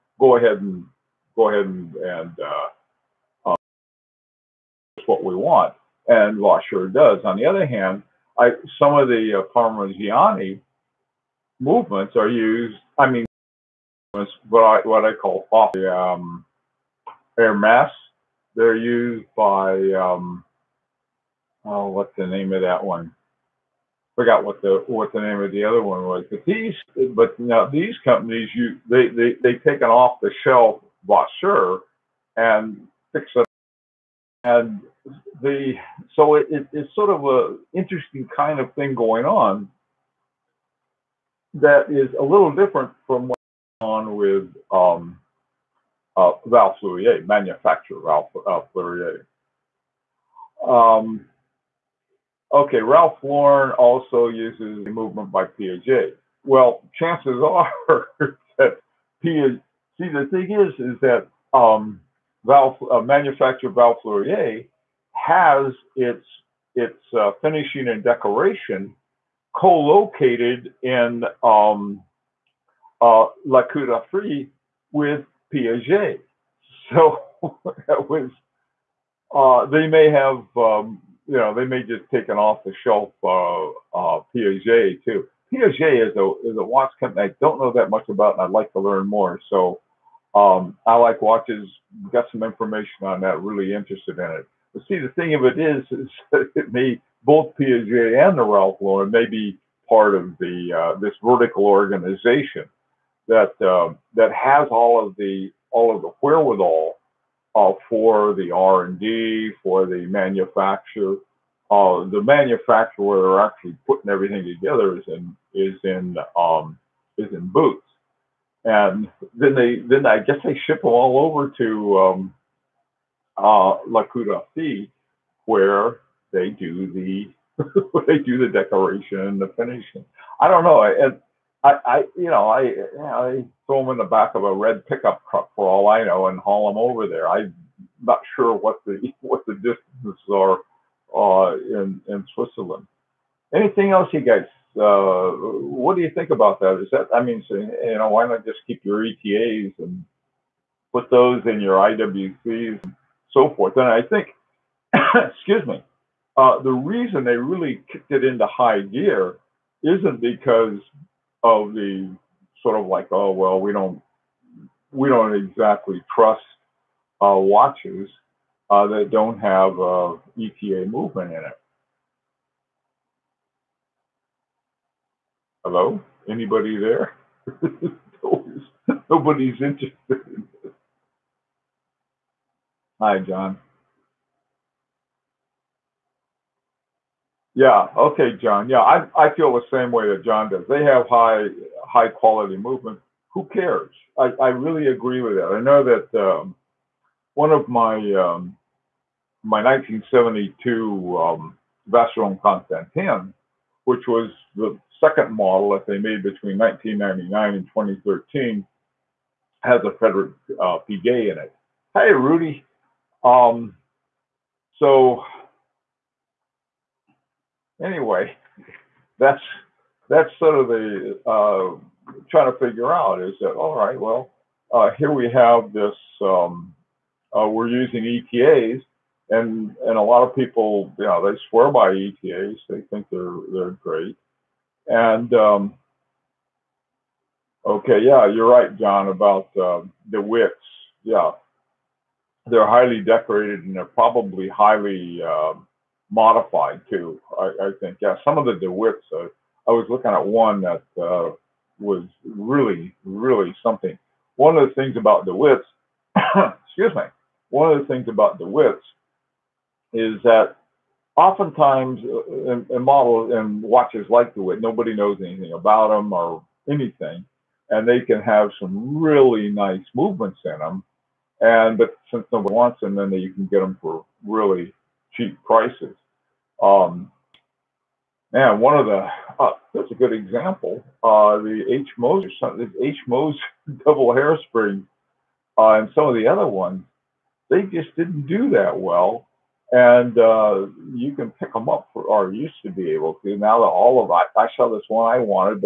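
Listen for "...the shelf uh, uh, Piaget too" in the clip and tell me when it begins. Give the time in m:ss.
1:22.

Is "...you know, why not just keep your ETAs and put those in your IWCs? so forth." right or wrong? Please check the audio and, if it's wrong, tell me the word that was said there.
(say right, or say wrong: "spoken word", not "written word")
right.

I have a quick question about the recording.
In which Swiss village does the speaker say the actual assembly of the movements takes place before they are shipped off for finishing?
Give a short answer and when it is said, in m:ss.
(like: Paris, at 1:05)
Buttes, at 1:57.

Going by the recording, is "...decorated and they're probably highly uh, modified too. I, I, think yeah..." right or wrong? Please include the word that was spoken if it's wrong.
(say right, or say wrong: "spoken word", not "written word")
right.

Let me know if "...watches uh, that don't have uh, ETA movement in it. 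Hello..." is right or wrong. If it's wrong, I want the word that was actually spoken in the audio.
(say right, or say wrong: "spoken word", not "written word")
right.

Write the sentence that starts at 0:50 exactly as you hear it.
Um, okay, Ralph Lauren also uses a movement by Piaget.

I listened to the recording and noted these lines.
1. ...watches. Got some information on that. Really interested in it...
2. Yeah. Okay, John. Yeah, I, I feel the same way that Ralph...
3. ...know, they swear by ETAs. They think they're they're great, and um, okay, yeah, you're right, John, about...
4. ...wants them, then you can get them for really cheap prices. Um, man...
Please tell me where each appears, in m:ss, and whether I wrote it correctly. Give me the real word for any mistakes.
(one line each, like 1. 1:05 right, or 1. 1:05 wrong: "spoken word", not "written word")
1. 1:31 right
2. 3:07 wrong: "John", not "Ralph"
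3. 3:51 right
4. 4:32 right.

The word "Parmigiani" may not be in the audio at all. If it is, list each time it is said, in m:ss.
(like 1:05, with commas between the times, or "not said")
0:09.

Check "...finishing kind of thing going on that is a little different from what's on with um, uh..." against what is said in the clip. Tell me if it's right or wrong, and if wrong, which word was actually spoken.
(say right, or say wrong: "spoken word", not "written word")
wrong: "interesting", not "finishing".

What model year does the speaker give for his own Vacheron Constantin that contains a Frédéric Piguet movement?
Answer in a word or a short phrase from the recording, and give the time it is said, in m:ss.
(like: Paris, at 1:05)
1972, at 3:19.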